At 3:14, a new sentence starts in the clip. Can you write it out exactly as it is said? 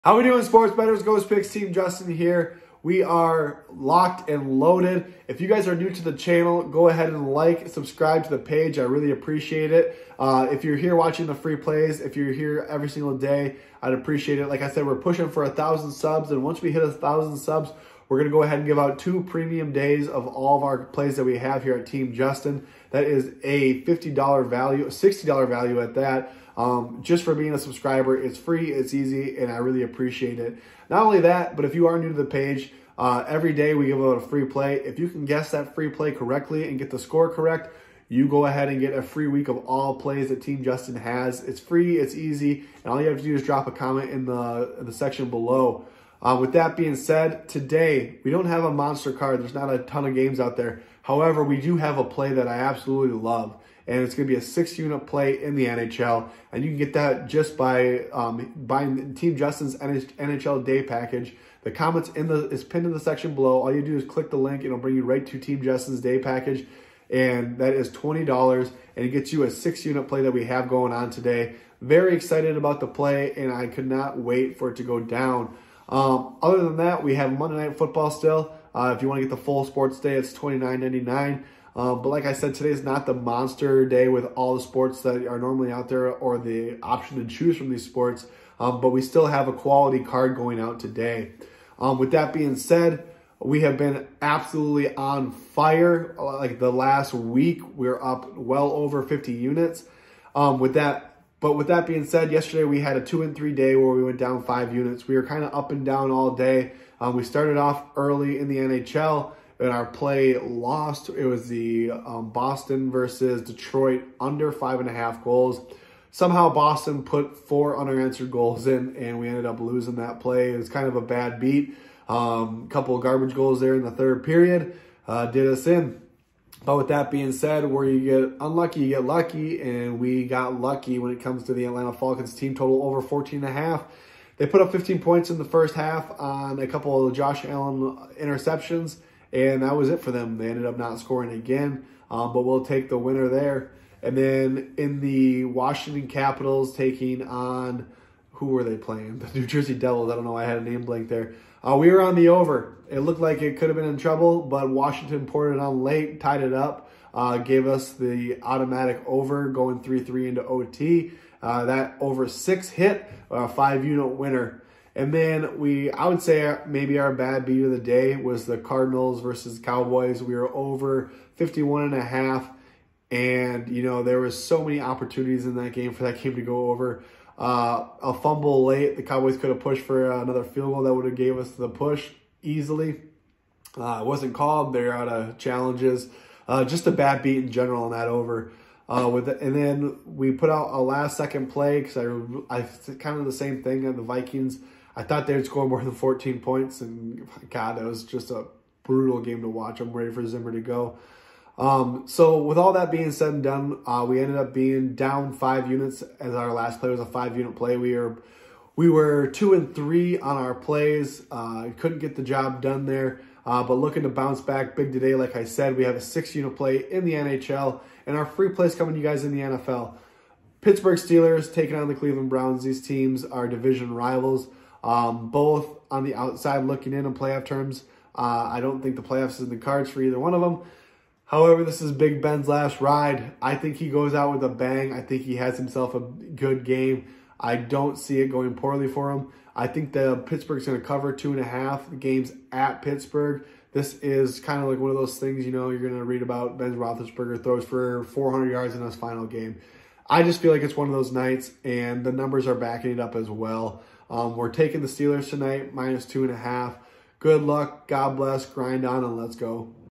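I thought they'd score more than 14 points, and God, that was just a brutal game to watch.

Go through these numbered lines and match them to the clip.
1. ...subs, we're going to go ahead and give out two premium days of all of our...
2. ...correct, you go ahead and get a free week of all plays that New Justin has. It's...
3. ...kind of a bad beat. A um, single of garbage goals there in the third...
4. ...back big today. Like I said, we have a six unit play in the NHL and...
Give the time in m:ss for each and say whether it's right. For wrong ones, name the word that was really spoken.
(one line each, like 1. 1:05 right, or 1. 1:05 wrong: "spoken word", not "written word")
1. 0:17 right
2. 0:37 wrong: "Team", not "New"
3. 2:00 wrong: "couple", not "single"
4. 3:34 right.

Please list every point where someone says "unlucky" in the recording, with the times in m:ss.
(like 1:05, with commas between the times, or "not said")
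2:08.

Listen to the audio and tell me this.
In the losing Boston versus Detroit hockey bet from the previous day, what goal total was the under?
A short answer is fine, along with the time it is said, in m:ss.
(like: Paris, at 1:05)
5.5, at 1:54.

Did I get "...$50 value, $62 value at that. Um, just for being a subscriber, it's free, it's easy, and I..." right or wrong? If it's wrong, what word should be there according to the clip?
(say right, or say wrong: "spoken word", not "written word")
wrong: "60", not "62".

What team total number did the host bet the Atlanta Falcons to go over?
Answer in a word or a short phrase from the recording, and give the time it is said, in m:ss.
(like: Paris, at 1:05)
14.5, at 2:13.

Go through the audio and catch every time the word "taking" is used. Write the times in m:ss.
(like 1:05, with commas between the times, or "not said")
2:26, 3:41, 4:14.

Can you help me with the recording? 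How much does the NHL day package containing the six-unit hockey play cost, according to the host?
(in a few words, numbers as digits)
$20.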